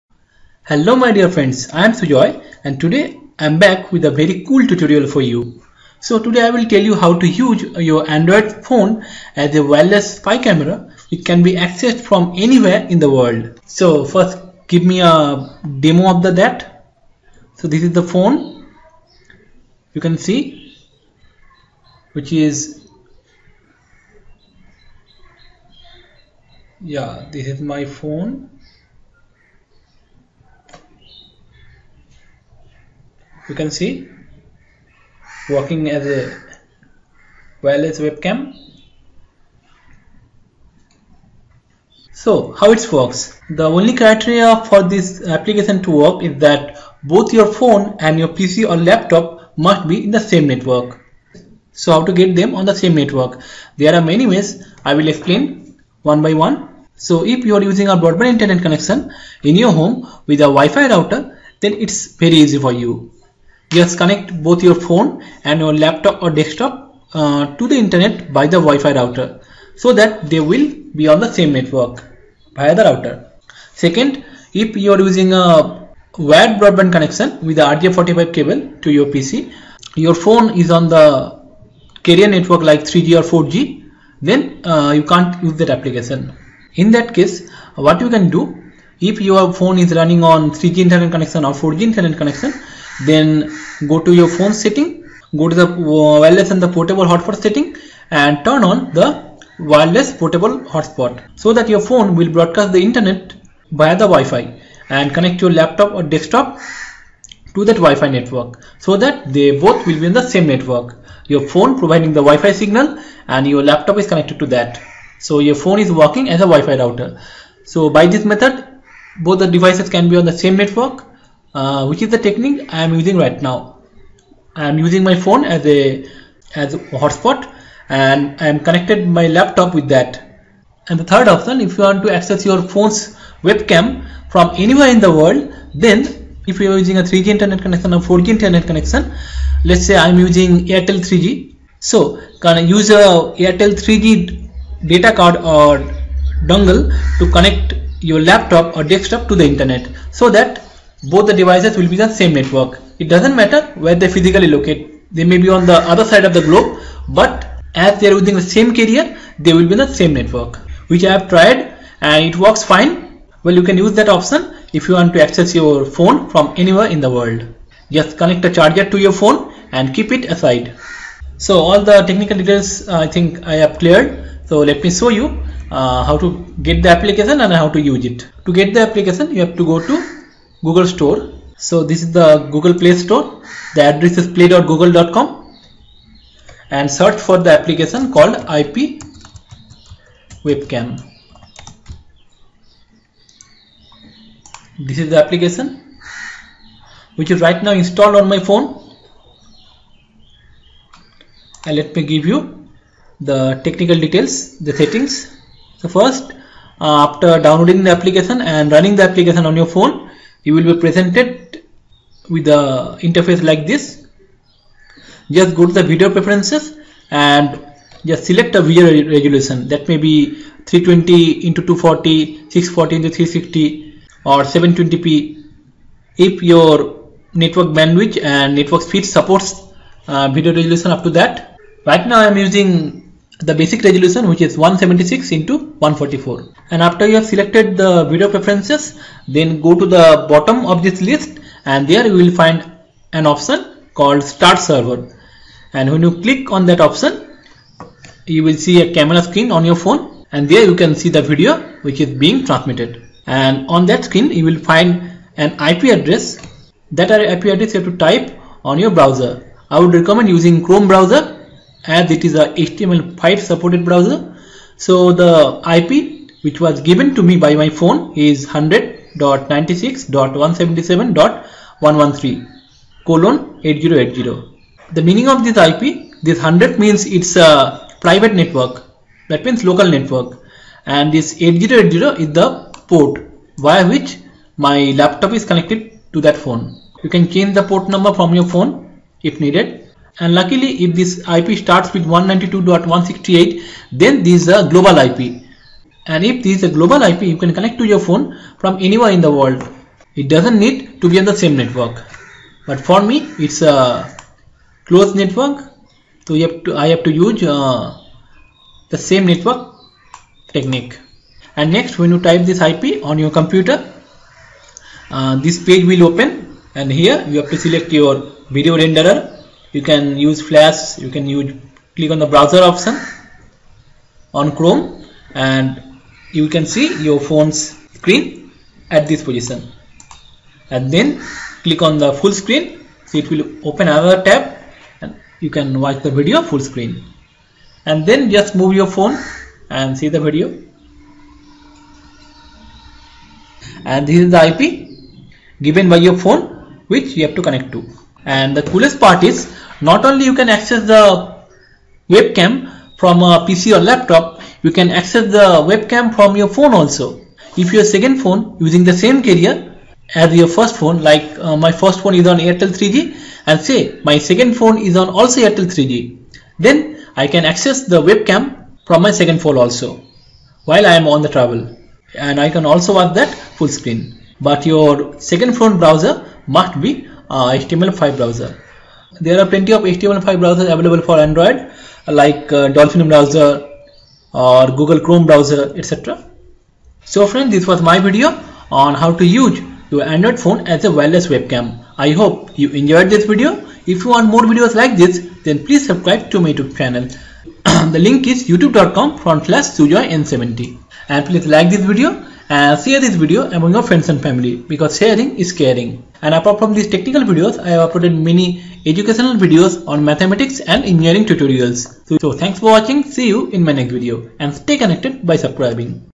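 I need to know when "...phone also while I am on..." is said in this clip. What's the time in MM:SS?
06:09.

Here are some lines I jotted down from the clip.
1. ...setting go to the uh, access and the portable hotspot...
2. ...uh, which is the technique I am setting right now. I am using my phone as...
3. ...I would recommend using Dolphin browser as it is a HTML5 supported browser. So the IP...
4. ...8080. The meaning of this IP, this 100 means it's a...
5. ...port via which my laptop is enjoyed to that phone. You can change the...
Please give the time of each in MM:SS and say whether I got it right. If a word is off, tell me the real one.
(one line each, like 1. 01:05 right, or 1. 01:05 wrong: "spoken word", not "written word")
1. 01:34 wrong: "wireless", not "access"
2. 02:01 wrong: "using", not "setting"
3. 04:19 wrong: "Chrome", not "Dolphin"
4. 04:33 right
5. 04:42 wrong: "connected", not "enjoyed".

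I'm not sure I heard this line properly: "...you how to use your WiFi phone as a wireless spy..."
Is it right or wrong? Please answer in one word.
wrong.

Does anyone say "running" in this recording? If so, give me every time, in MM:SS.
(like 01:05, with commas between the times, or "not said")
01:29, 03:28.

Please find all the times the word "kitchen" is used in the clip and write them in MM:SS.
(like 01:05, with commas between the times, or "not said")
not said.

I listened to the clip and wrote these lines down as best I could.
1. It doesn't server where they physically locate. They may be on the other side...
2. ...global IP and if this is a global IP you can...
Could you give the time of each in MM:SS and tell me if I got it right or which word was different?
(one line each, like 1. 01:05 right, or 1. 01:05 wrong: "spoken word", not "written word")
1. 02:32 wrong: "matter", not "server"
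2. 04:54 right.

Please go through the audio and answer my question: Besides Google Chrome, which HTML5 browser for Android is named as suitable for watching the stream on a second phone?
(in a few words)
Dolphin.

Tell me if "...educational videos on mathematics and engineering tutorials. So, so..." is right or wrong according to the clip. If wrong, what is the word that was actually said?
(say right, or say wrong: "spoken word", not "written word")
right.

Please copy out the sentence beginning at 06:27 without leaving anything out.
So friends this was my video on how to use your Android phone as a wireless webcam.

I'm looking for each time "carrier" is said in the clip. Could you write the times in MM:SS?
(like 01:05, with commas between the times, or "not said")
01:22, 02:38, 05:59.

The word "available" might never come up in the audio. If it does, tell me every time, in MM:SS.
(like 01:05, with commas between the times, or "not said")
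06:20.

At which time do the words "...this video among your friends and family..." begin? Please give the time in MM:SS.
06:43.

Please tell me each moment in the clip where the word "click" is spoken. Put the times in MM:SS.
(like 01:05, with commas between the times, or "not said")
04:06, 05:21, 05:31.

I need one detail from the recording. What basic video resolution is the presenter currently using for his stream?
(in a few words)
176 x 144.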